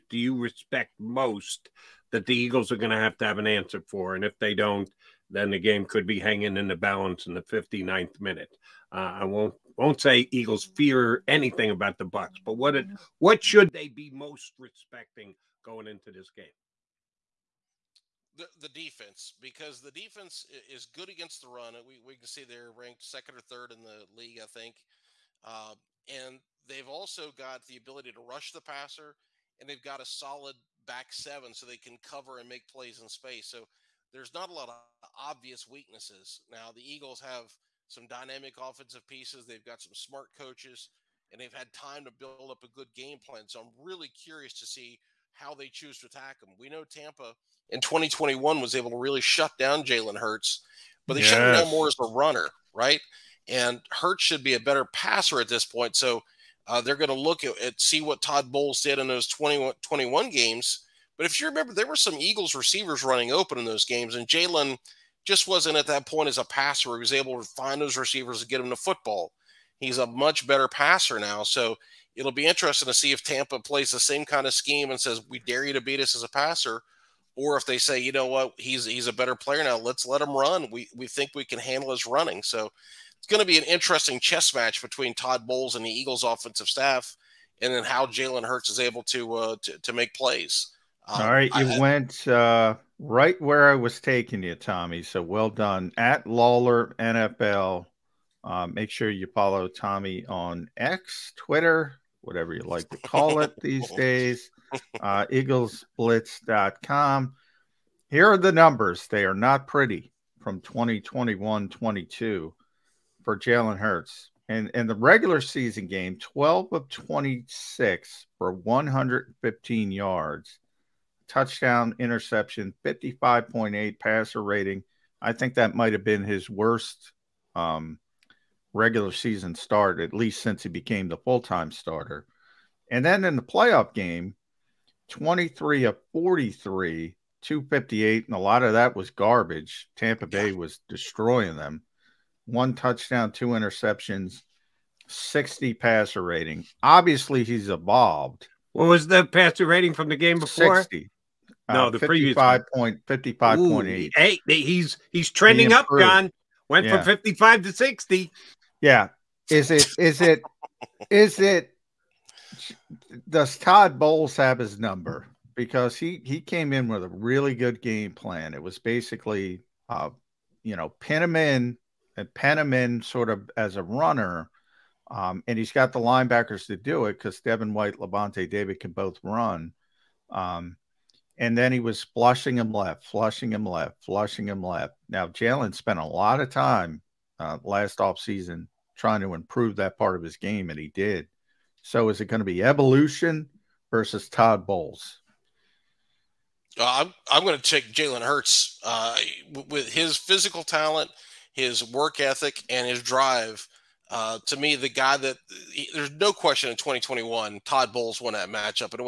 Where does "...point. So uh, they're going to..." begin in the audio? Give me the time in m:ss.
0:55.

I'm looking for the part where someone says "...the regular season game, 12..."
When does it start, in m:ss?
1:54.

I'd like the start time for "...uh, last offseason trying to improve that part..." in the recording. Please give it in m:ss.
3:07.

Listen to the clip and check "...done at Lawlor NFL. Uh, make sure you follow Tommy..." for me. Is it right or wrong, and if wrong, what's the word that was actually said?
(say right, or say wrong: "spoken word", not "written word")
right.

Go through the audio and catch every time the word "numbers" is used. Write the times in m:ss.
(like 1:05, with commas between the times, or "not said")
1:48, 2:44.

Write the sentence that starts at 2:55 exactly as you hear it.
Um, and he's got the linebackers to do it because Devin White, Lavonte David can both run.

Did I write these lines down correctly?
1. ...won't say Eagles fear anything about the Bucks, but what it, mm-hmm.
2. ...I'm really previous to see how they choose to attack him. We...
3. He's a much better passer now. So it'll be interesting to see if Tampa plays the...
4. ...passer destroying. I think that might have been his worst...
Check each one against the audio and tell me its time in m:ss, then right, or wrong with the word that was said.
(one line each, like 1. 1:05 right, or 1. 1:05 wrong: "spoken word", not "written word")
1. 0:09 right
2. 0:43 wrong: "curious", not "previous"
3. 1:09 right
4. 2:03 wrong: "rating", not "destroying".